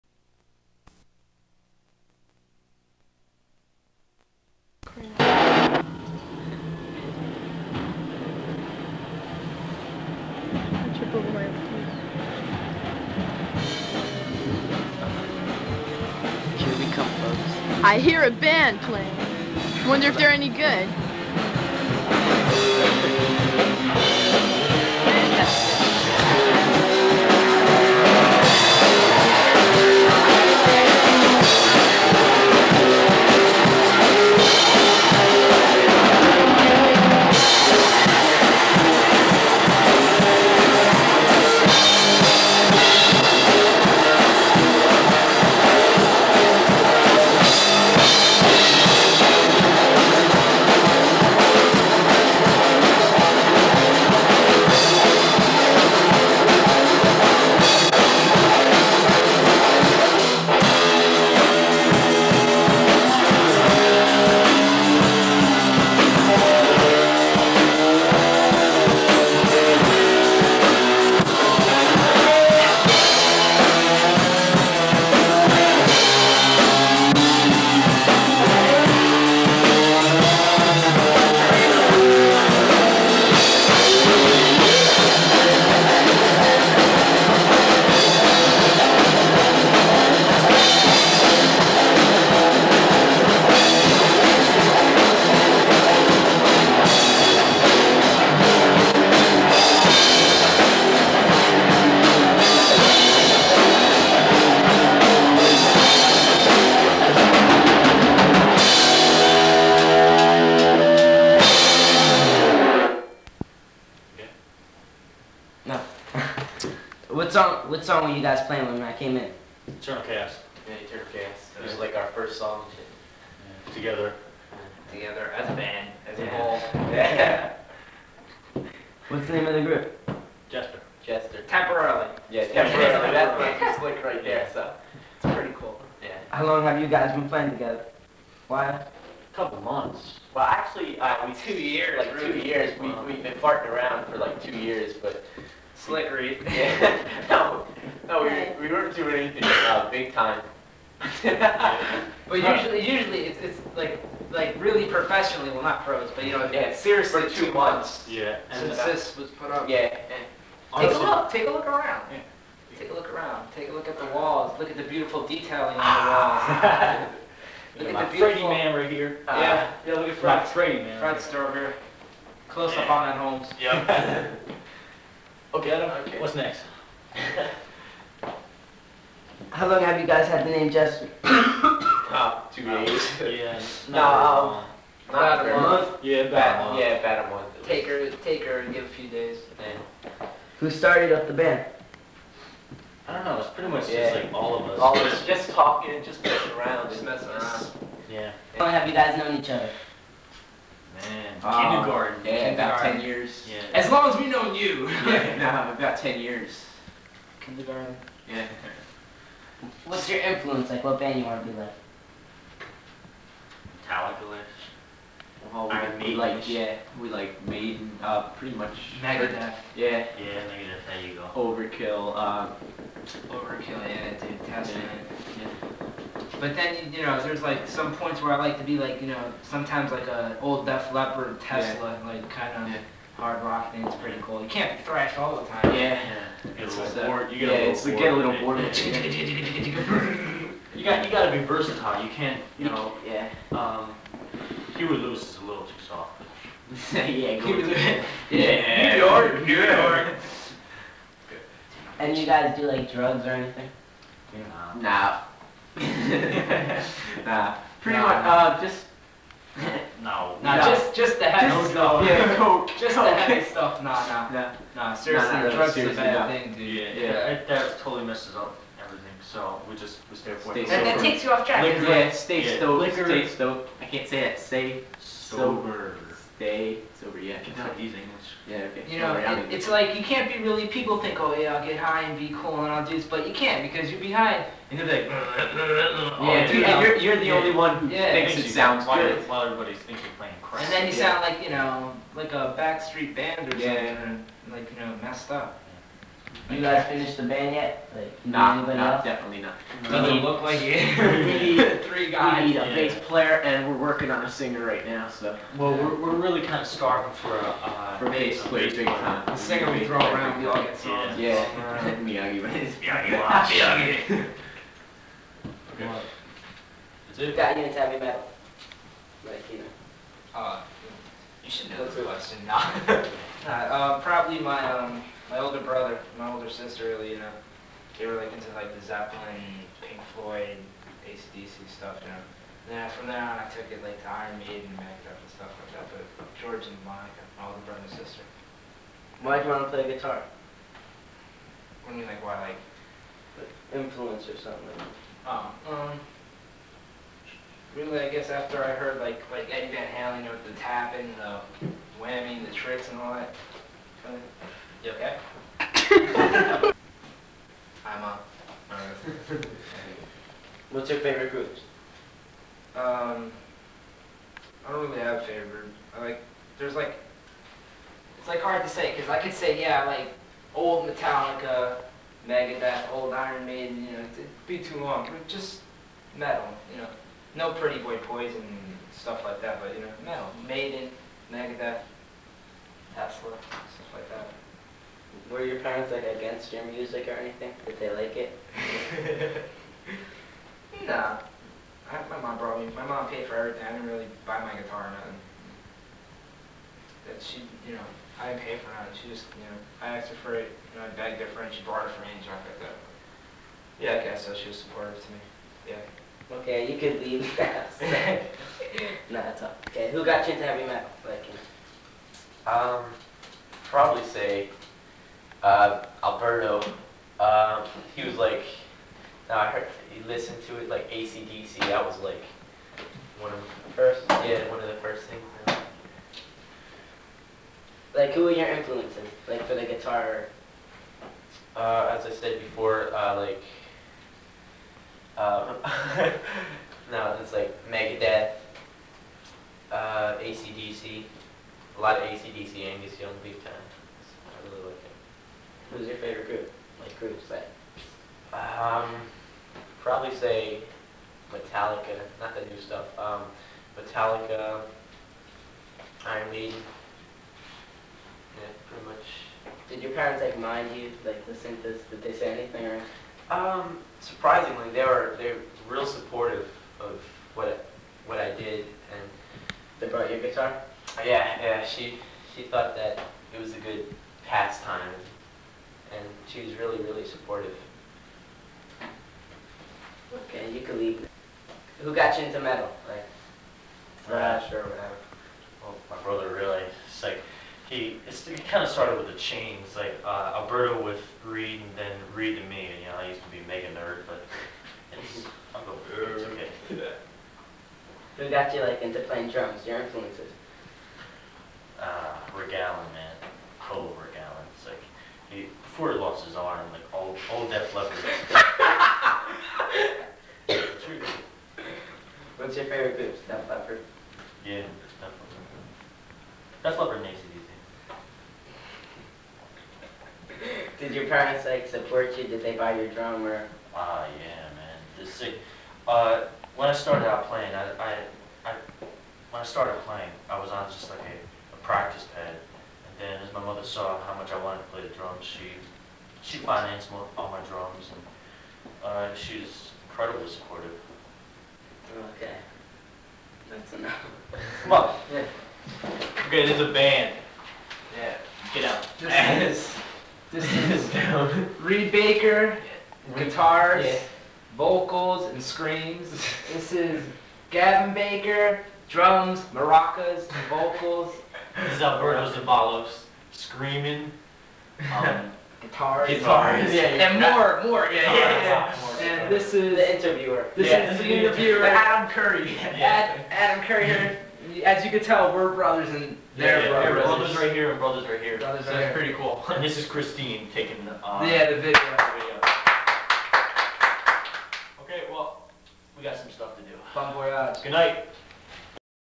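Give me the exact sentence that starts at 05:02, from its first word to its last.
bass player, and we're working on a singer right now.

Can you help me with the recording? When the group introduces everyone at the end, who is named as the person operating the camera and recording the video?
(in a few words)
Christine.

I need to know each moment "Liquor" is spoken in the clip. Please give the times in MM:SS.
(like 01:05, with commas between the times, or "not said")
04:31.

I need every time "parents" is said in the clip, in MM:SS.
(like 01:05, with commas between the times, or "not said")
06:25, 07:39, 08:41.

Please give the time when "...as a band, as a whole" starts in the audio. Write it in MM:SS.
02:05.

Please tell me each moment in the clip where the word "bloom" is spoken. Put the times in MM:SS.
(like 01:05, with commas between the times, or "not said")
not said.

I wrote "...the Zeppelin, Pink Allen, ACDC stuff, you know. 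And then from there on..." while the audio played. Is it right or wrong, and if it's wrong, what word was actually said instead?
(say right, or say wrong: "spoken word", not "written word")
wrong: "Floyd", not "Allen".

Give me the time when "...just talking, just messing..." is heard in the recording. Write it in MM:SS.
03:15.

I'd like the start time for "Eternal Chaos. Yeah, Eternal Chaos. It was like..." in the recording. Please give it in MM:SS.
01:59.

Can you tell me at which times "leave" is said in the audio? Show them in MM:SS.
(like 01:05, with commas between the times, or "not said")
06:47, 08:00.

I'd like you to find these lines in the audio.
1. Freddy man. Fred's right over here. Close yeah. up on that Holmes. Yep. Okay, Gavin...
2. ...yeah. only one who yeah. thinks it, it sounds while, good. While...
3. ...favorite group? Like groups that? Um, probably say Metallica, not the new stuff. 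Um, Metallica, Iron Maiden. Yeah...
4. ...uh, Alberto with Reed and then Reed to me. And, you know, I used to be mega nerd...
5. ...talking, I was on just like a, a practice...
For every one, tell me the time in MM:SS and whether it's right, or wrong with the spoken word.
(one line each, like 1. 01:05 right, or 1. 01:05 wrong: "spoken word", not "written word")
1. 02:50 wrong: "Adam", not "Gavin"
2. 04:47 right
3. 07:25 right
4. 08:10 right
5. 08:49 wrong: "playing", not "talking".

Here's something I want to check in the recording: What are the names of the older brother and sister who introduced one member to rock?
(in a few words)
George and Monica.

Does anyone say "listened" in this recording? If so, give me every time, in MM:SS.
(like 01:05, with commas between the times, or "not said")
07:00.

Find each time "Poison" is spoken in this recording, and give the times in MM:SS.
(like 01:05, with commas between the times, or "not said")
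06:17.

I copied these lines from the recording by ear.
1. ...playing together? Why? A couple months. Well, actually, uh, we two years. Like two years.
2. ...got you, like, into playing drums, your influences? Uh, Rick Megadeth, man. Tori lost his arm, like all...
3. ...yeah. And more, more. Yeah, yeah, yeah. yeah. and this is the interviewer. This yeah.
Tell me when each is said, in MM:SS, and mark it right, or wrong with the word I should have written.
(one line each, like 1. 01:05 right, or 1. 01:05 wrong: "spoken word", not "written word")
1. 02:17 right
2. 08:18 wrong: "Allen", not "Megadeth"
3. 09:26 right.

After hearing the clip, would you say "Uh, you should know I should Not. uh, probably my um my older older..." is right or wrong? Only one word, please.
wrong.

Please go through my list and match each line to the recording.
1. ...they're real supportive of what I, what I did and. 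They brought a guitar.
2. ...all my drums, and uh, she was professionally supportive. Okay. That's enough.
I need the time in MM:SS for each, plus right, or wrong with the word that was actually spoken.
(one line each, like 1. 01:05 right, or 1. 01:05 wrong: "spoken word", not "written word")
1. 07:45 right
2. 08:57 wrong: "incredibly", not "professionally".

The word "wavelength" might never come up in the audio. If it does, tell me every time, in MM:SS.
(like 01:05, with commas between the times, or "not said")
not said.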